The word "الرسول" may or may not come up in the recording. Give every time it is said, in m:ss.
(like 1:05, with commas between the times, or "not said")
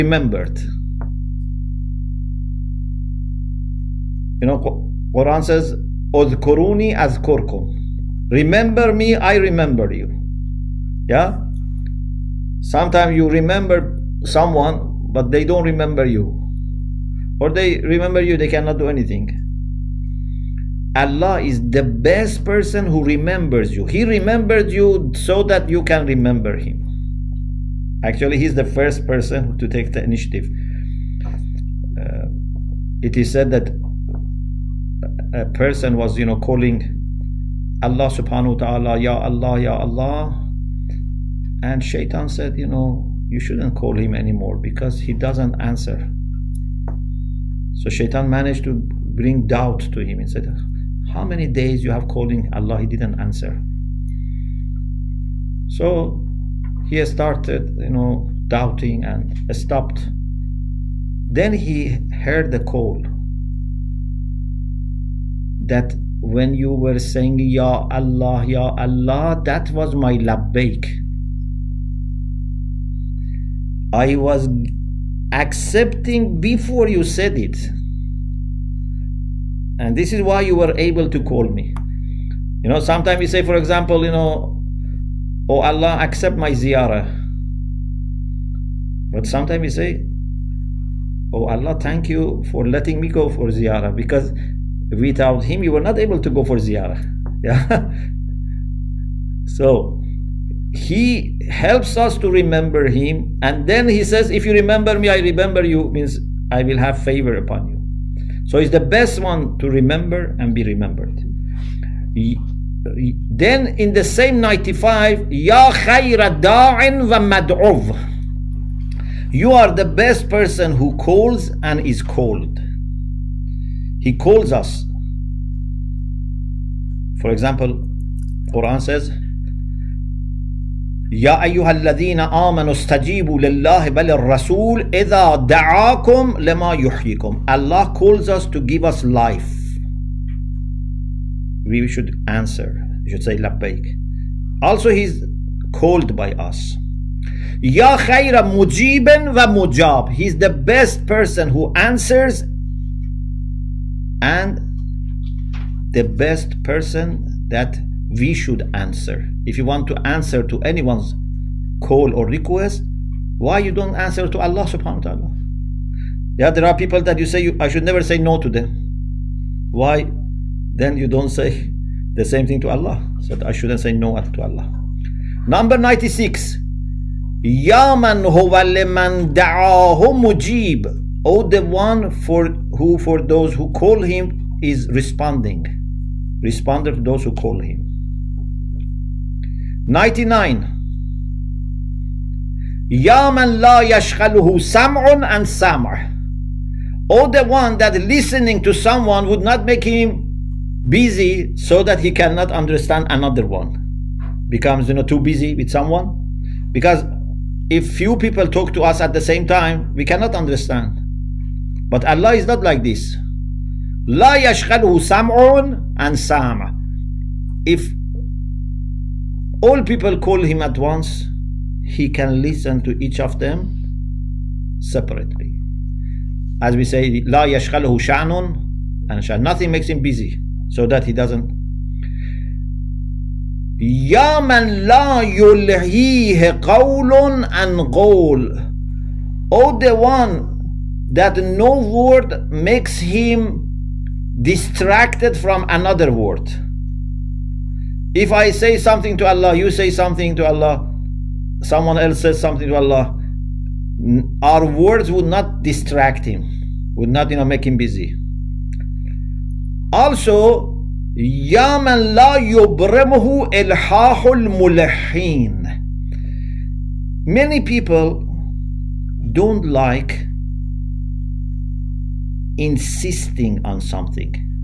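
2:14.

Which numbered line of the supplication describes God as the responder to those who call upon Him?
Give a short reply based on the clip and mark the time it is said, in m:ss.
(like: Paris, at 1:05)
96, at 2:55.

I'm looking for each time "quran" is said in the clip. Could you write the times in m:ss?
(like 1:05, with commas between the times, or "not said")
0:05, 2:08.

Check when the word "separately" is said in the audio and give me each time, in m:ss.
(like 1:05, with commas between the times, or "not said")
3:44.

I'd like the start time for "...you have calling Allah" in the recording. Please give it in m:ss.
0:51.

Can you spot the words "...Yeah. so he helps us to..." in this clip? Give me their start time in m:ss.
1:37.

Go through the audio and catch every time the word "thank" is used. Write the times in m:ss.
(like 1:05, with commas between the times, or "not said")
1:31.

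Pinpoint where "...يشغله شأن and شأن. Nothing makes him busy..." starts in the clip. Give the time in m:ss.
3:47.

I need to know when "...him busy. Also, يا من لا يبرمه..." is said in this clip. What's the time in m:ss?
4:17.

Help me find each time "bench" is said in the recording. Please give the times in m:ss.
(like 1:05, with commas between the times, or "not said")
not said.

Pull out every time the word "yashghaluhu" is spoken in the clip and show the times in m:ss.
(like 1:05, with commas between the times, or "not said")
3:13, 3:34.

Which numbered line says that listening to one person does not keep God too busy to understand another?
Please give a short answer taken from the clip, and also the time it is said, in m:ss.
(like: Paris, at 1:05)
99, at 3:09.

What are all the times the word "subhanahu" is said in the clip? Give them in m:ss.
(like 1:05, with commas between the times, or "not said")
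0:38, 2:44.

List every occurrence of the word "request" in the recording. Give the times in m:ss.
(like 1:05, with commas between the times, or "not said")
2:42.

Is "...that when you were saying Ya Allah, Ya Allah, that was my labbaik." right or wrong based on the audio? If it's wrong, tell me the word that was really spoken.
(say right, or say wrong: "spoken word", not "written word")
right.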